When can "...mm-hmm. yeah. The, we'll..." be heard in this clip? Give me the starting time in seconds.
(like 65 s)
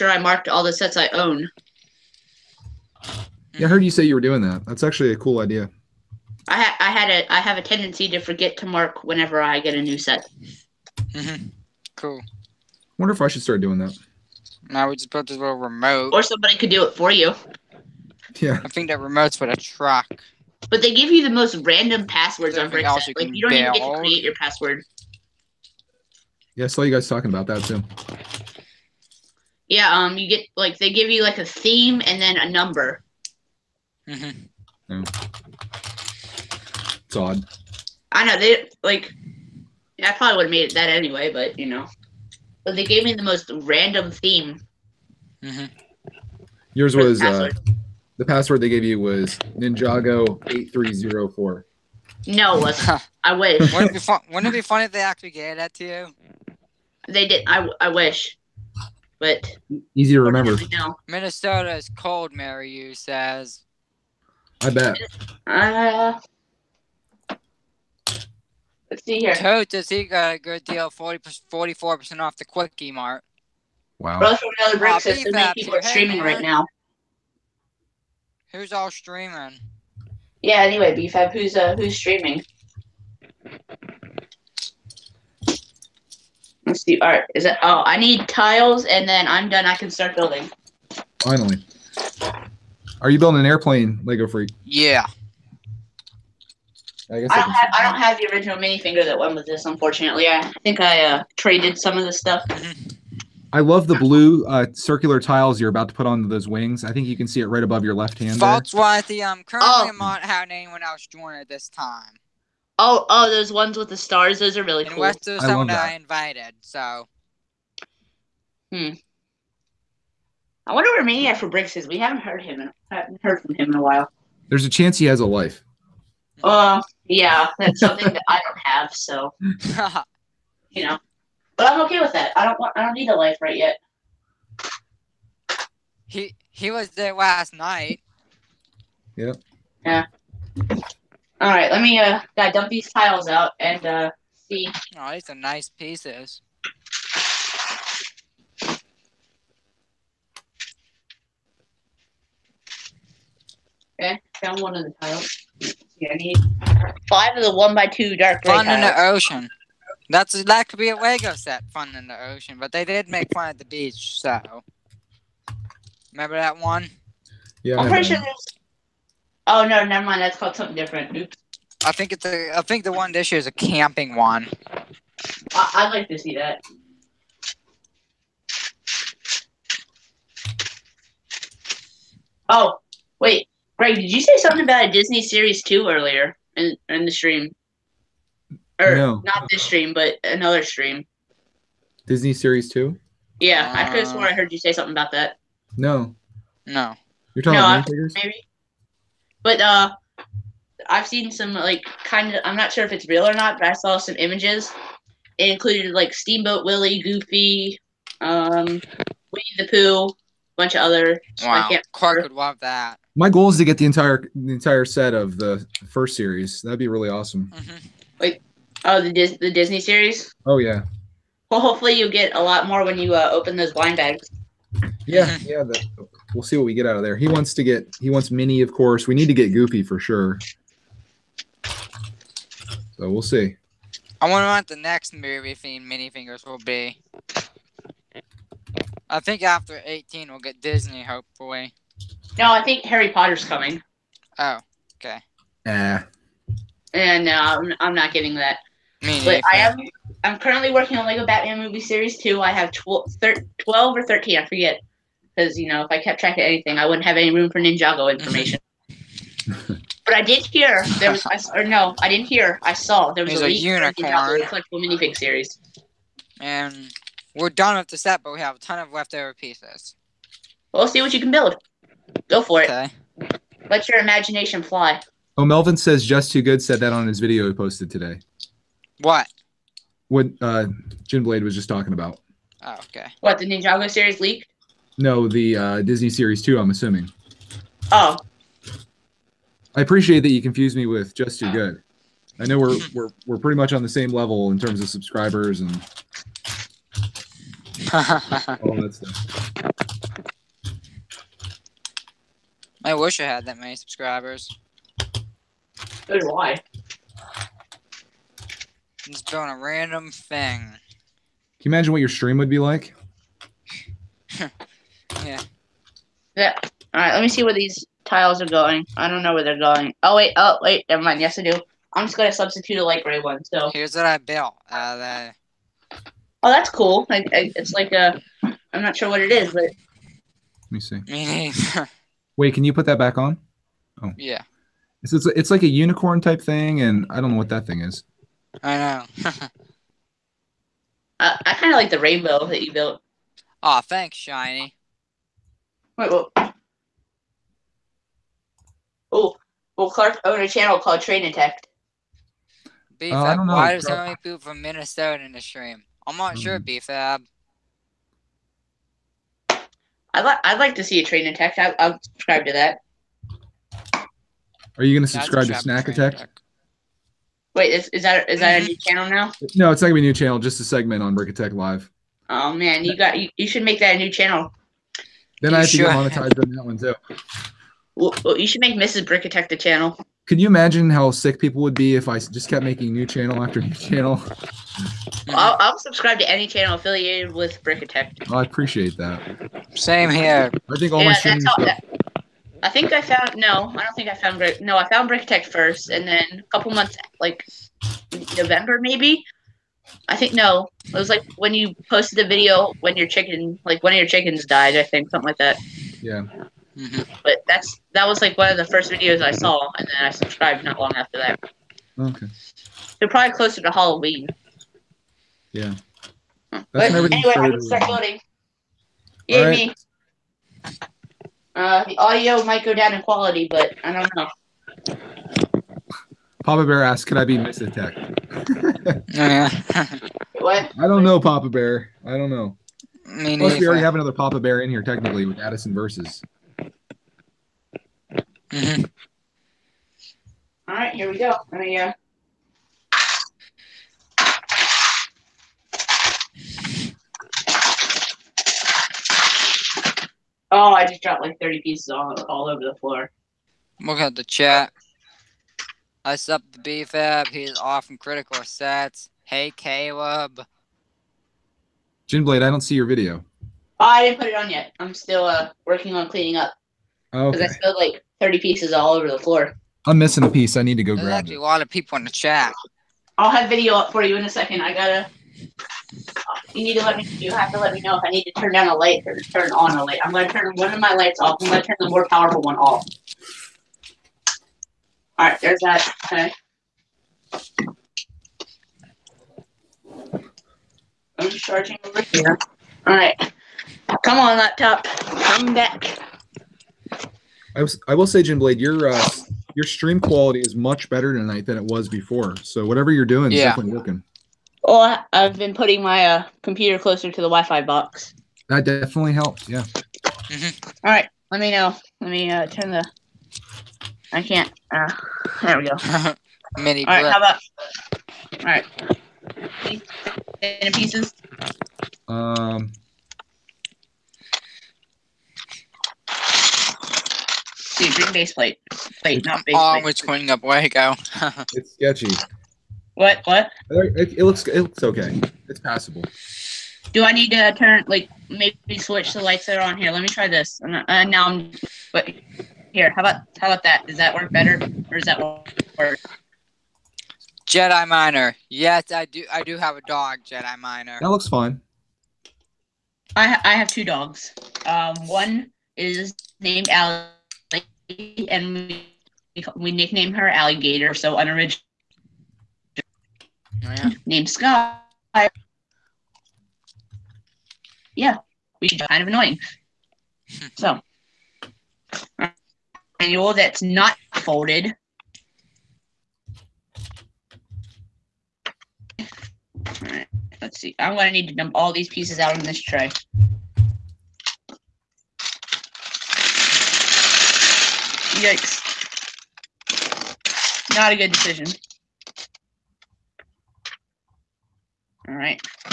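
225 s.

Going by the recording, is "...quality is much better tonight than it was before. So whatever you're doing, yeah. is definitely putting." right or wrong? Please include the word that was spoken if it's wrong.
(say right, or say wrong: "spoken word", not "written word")
wrong: "working", not "putting".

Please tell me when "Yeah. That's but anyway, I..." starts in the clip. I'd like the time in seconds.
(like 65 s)
415 s.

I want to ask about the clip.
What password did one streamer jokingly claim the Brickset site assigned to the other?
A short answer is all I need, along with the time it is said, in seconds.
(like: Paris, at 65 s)
Ninjago8304, at 49 s.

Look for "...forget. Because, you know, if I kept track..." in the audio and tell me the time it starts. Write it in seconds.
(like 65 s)
254 s.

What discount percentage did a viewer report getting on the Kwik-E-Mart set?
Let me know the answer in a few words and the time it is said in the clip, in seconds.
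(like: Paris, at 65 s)
44%, at 70 s.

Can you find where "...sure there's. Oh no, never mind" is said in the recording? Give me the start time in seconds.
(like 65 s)
168 s.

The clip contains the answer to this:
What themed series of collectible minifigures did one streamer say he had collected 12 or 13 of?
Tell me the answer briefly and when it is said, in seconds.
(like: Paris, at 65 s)
Lego Batman movie series two, at 251 s.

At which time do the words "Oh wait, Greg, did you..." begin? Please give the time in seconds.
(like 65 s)
182 s.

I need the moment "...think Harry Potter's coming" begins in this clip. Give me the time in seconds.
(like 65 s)
242 s.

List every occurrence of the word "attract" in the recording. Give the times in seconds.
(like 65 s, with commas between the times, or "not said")
not said.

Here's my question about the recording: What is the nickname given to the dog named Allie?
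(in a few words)
Alligator.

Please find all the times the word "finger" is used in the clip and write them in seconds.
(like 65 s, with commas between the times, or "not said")
98 s, 236 s.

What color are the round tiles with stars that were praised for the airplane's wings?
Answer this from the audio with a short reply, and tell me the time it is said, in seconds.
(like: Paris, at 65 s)
blue, at 103 s.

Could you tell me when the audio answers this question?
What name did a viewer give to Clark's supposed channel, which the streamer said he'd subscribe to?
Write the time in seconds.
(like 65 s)
351 s.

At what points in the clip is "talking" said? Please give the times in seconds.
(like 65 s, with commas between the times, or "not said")
27 s, 197 s, 281 s.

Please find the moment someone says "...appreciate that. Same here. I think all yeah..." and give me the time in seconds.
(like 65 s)
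388 s.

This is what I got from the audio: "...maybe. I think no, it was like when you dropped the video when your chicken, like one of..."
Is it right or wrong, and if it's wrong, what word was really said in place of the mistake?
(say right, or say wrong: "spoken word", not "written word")
wrong: "posted", not "dropped".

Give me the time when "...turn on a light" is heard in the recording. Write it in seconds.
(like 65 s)
479 s.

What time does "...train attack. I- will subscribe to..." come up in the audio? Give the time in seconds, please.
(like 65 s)
361 s.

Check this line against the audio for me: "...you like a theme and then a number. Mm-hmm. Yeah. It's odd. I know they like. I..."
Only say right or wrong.
right.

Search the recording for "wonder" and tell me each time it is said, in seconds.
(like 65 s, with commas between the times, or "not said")
12 s, 120 s, 234 s.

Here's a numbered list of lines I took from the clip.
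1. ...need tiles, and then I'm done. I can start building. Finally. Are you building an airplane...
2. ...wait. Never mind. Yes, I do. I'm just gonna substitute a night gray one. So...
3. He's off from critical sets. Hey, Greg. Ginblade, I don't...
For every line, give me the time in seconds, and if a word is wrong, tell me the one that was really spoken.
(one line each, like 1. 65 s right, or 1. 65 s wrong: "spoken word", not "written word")
1. 87 s right
2. 320 s wrong: "light", not "night"
3. 457 s wrong: "Caleb", not "Greg".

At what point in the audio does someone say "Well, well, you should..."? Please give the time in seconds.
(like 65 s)
377 s.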